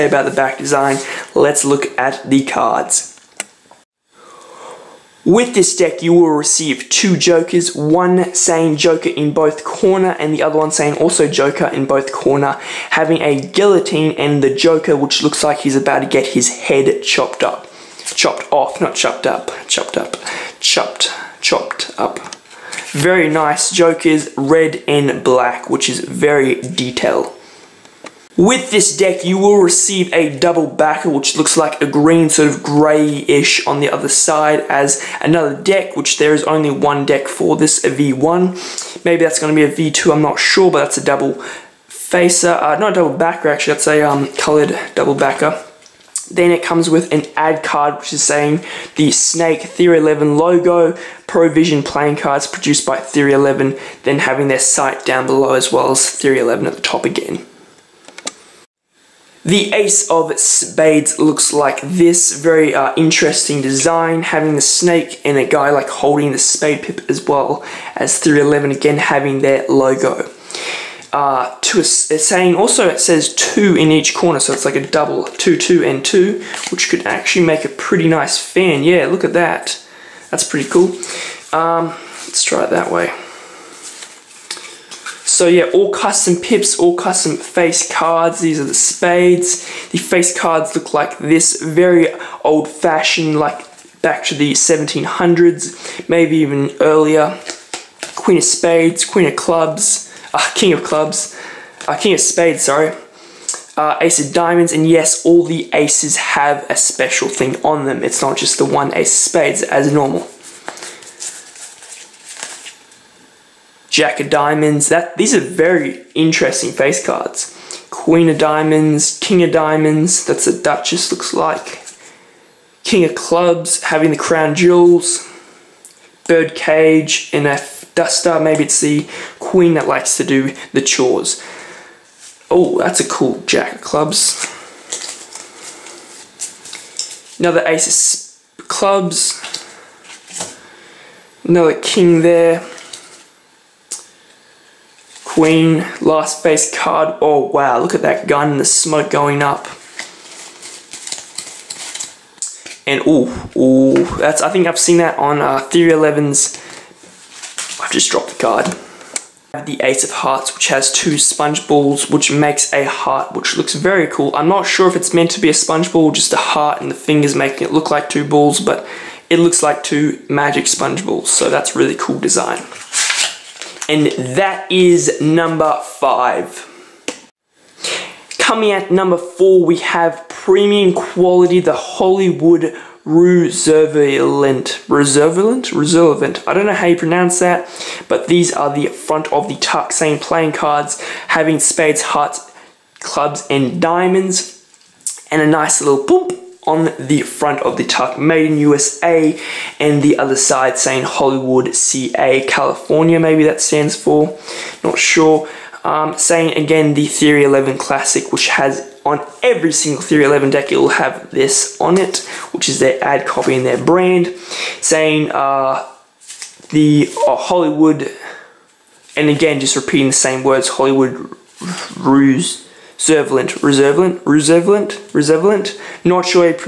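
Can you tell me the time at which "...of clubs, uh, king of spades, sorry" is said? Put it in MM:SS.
01:40.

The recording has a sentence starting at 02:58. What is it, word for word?
Coming at number four, we have premium quality, the Hollywood Reservalent.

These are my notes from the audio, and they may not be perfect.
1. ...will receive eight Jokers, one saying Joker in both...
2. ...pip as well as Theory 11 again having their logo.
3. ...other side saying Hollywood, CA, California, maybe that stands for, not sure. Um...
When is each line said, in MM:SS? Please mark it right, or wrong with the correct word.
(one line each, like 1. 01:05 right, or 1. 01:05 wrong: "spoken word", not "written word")
1. 00:06 wrong: "two", not "eight"
2. 01:06 right
3. 03:20 right.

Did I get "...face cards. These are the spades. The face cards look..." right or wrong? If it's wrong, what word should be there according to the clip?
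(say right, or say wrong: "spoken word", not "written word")
right.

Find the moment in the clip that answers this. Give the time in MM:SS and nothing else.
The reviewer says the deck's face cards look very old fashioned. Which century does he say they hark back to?
01:34.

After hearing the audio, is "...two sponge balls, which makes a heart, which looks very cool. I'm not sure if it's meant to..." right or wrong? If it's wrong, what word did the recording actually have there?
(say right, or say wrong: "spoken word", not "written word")
right.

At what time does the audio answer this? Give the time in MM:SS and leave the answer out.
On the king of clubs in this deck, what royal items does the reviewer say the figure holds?
02:04.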